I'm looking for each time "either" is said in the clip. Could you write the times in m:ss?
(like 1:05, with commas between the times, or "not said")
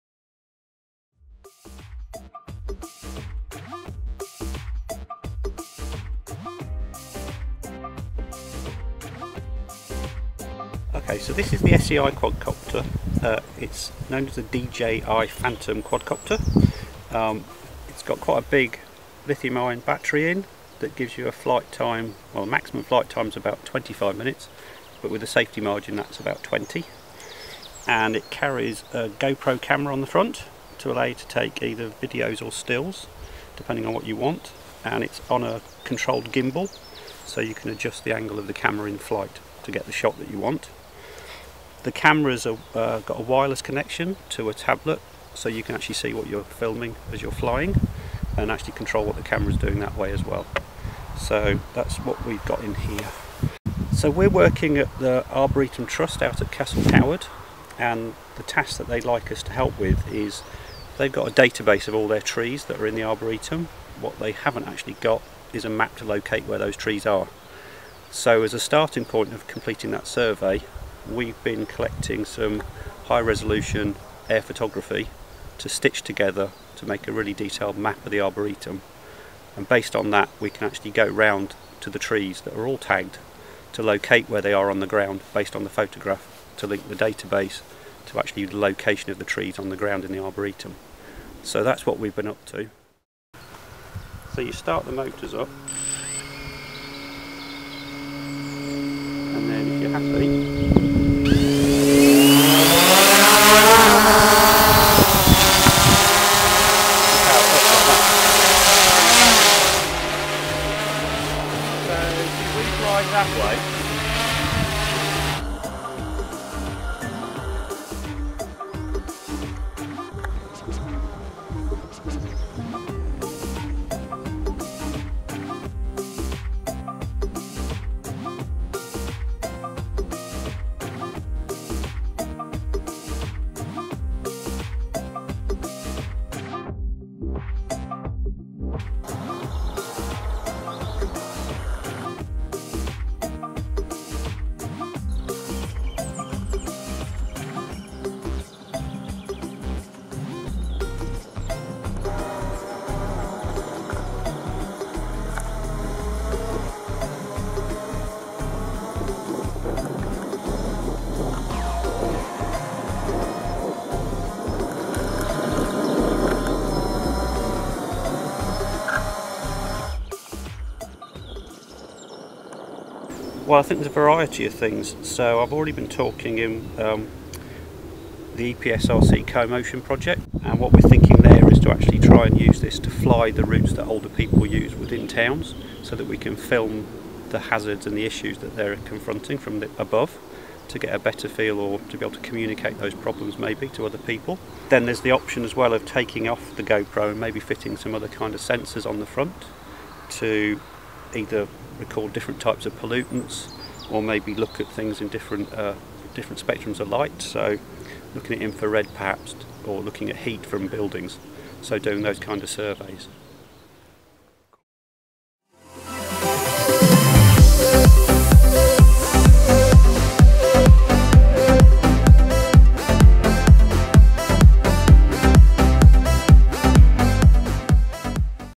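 0:31, 3:21.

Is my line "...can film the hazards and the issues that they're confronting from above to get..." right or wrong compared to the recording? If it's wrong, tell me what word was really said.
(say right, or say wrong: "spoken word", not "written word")
right.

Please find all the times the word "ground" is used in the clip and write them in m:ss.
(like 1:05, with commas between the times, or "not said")
1:24, 1:29.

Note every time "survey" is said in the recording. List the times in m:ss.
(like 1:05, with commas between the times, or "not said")
1:10, 3:32.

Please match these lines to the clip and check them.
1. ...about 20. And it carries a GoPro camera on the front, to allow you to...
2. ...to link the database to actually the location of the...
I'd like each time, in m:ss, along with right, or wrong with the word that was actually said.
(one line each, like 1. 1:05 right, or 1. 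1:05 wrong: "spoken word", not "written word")
1. 0:26 right
2. 1:26 right.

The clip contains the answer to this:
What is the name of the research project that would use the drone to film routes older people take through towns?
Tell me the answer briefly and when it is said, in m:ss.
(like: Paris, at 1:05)
EPSRC co-motion, at 2:58.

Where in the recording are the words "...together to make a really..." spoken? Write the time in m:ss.
1:16.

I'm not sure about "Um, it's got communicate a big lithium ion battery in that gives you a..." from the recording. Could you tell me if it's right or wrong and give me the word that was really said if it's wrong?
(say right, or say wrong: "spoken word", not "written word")
wrong: "quite", not "communicate".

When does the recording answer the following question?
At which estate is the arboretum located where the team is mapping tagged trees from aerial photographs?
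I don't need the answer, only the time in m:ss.
0:56.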